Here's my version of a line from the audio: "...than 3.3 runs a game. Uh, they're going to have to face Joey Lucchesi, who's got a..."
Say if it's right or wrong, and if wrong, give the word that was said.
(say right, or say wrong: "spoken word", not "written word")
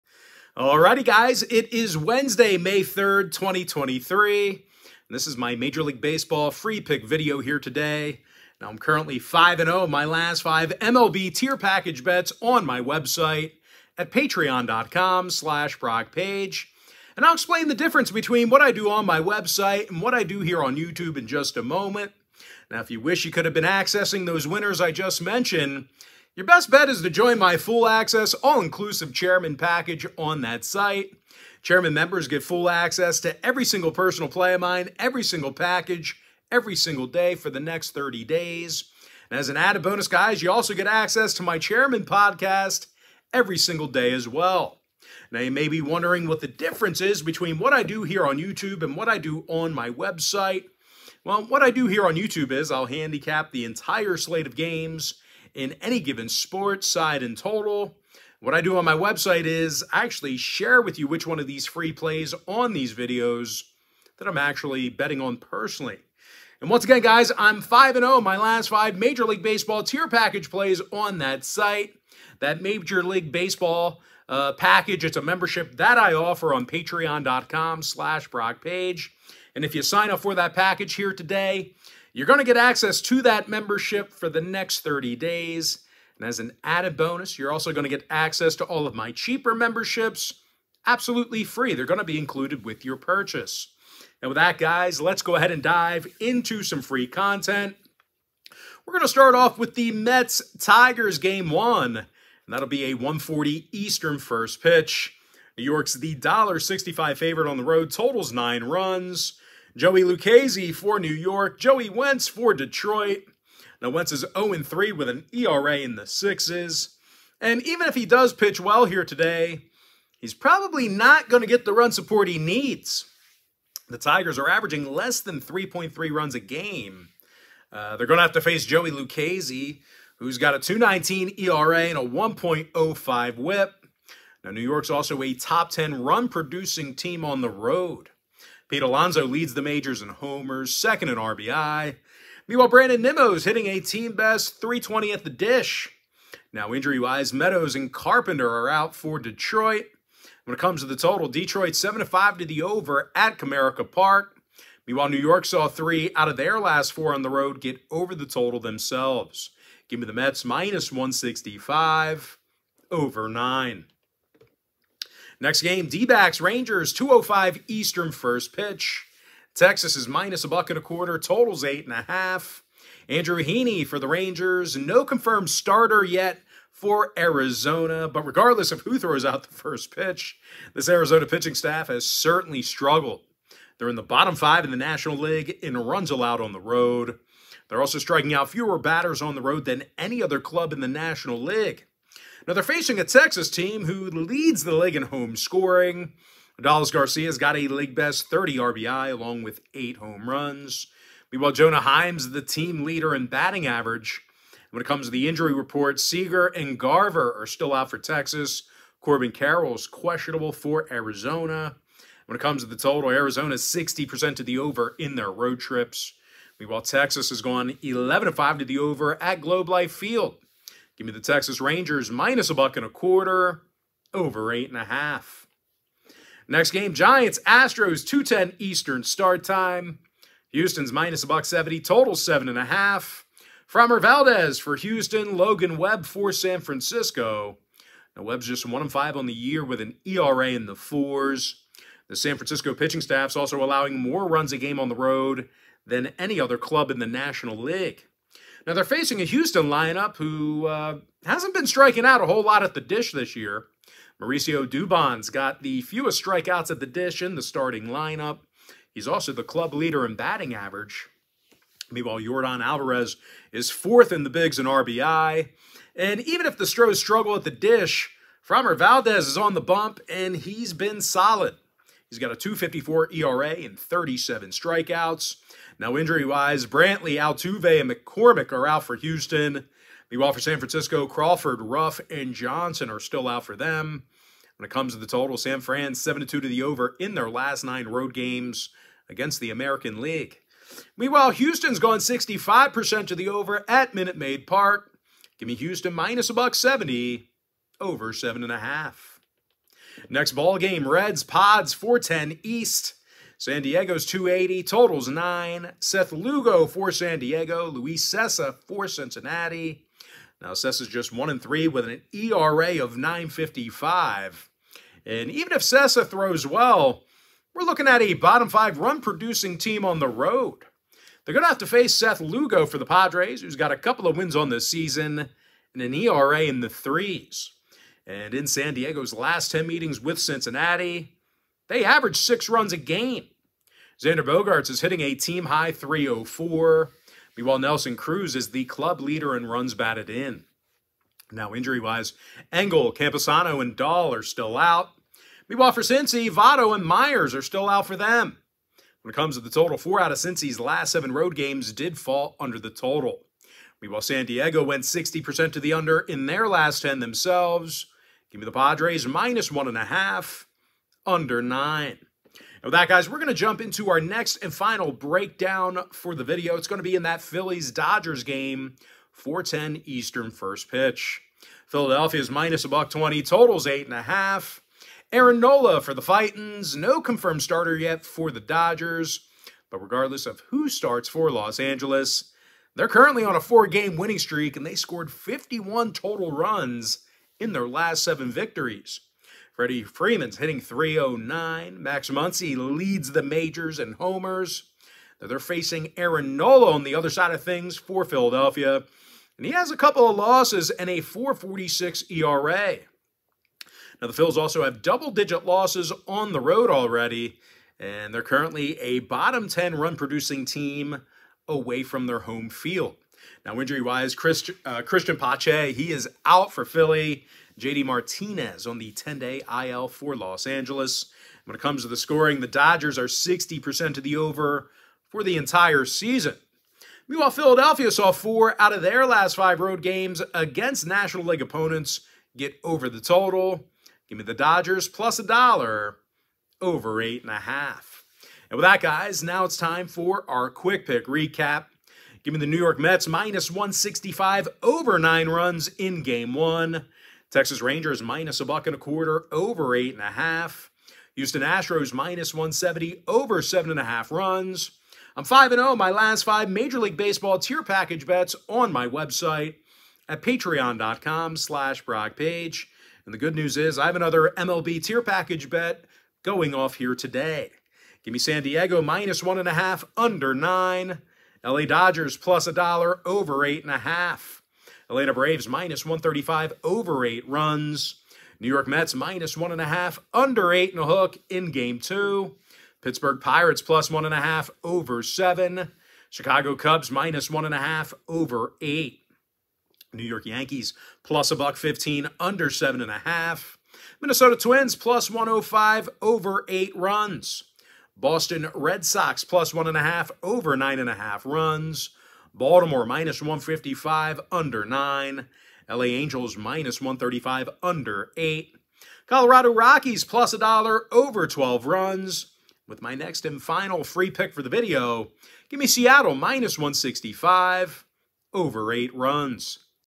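right.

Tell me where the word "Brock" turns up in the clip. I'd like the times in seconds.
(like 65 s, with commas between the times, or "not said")
78 s, 461 s.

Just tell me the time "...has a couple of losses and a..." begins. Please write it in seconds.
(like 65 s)
399 s.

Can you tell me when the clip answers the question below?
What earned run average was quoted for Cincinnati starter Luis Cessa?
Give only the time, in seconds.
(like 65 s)
312 s.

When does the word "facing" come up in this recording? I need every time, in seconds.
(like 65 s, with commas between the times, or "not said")
192 s, 248 s, 395 s.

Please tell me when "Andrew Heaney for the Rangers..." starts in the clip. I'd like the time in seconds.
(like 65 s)
173 s.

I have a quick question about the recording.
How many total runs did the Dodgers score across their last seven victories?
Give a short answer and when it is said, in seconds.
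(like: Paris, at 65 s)
51, at 385 s.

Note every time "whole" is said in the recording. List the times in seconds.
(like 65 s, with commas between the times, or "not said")
252 s.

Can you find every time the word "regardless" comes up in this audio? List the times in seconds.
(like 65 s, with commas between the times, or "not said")
178 s, 379 s.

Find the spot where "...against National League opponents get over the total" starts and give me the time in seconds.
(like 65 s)
430 s.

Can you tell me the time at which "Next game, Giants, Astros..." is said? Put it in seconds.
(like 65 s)
226 s.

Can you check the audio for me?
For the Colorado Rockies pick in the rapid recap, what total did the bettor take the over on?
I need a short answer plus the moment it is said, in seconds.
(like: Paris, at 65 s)
12 runs, at 511 s.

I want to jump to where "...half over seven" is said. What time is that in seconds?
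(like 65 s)
484 s.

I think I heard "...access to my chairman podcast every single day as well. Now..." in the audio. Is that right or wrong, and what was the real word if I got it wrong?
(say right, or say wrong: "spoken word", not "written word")
right.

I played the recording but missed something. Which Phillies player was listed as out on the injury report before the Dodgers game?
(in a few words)
Cristian Pache.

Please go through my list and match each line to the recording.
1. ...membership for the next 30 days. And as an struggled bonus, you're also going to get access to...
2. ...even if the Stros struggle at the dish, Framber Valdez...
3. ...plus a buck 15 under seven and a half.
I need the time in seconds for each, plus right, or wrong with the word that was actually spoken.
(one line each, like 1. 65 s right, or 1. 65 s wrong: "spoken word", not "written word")
1. 83 s wrong: "added", not "struggled"
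2. 266 s right
3. 491 s right.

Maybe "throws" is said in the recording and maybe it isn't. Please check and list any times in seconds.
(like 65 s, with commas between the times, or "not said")
178 s, 316 s.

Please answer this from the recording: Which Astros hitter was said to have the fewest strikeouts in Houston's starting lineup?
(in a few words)
Mauricio Dubon.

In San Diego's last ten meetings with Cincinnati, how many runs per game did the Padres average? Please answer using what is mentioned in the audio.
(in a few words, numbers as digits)
6.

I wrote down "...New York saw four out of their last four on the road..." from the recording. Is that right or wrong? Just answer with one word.
wrong.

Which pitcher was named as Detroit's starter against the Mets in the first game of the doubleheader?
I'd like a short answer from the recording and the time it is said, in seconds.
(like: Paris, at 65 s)
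Joey Wentz, at 111 s.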